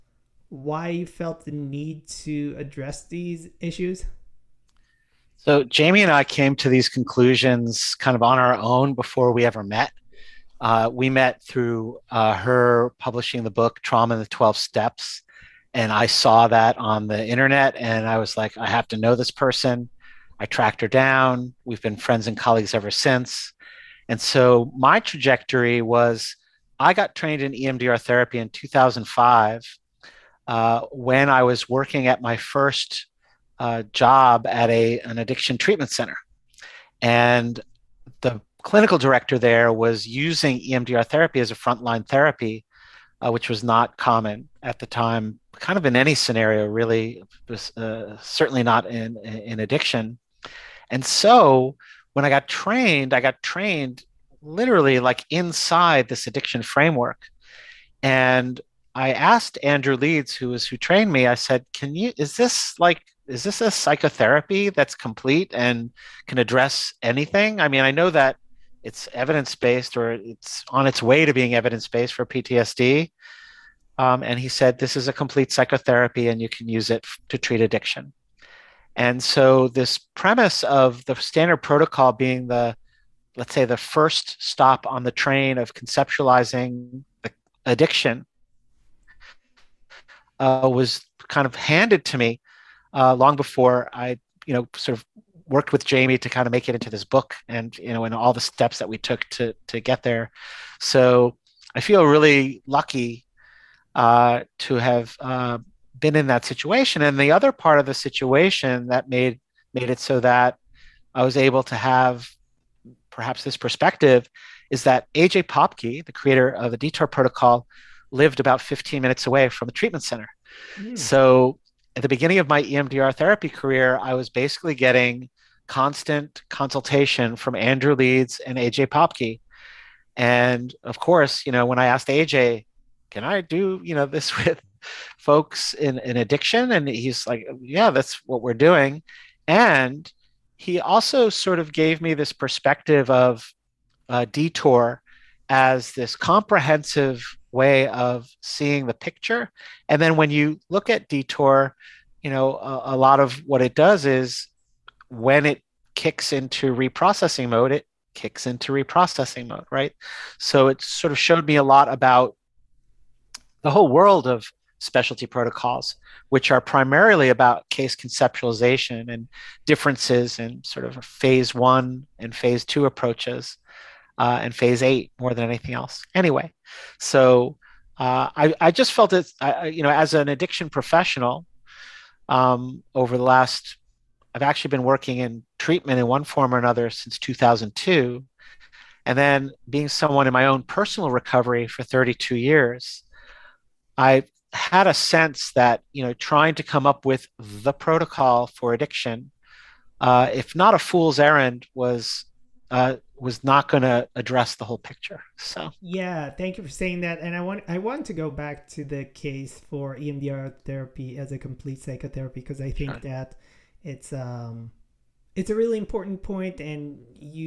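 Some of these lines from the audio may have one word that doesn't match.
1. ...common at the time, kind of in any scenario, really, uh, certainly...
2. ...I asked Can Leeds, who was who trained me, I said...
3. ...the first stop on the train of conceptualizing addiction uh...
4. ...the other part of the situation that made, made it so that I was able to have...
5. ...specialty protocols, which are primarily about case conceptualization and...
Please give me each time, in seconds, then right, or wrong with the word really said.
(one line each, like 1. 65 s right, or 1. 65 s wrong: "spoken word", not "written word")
1. 43 s right
2. 58 s wrong: "Andrew", not "Can"
3. 83 s right
4. 107 s right
5. 164 s right.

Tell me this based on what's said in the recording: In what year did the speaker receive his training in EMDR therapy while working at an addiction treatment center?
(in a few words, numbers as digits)
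2005.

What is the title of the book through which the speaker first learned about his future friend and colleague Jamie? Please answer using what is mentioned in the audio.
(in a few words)
Trauma and the 12 Steps.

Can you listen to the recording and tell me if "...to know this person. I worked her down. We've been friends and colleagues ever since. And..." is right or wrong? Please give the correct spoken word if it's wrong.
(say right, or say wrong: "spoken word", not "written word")
wrong: "tracked", not "worked".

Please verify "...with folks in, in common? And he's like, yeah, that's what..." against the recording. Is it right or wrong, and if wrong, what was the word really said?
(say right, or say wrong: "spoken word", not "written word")
wrong: "addiction", not "common".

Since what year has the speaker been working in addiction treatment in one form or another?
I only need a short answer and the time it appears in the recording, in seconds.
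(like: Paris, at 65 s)
2002, at 187 s.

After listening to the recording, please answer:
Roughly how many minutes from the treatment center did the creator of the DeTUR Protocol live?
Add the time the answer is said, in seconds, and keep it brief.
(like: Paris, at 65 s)
15 minutes, at 118 s.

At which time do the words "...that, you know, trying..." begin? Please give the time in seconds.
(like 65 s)
195 s.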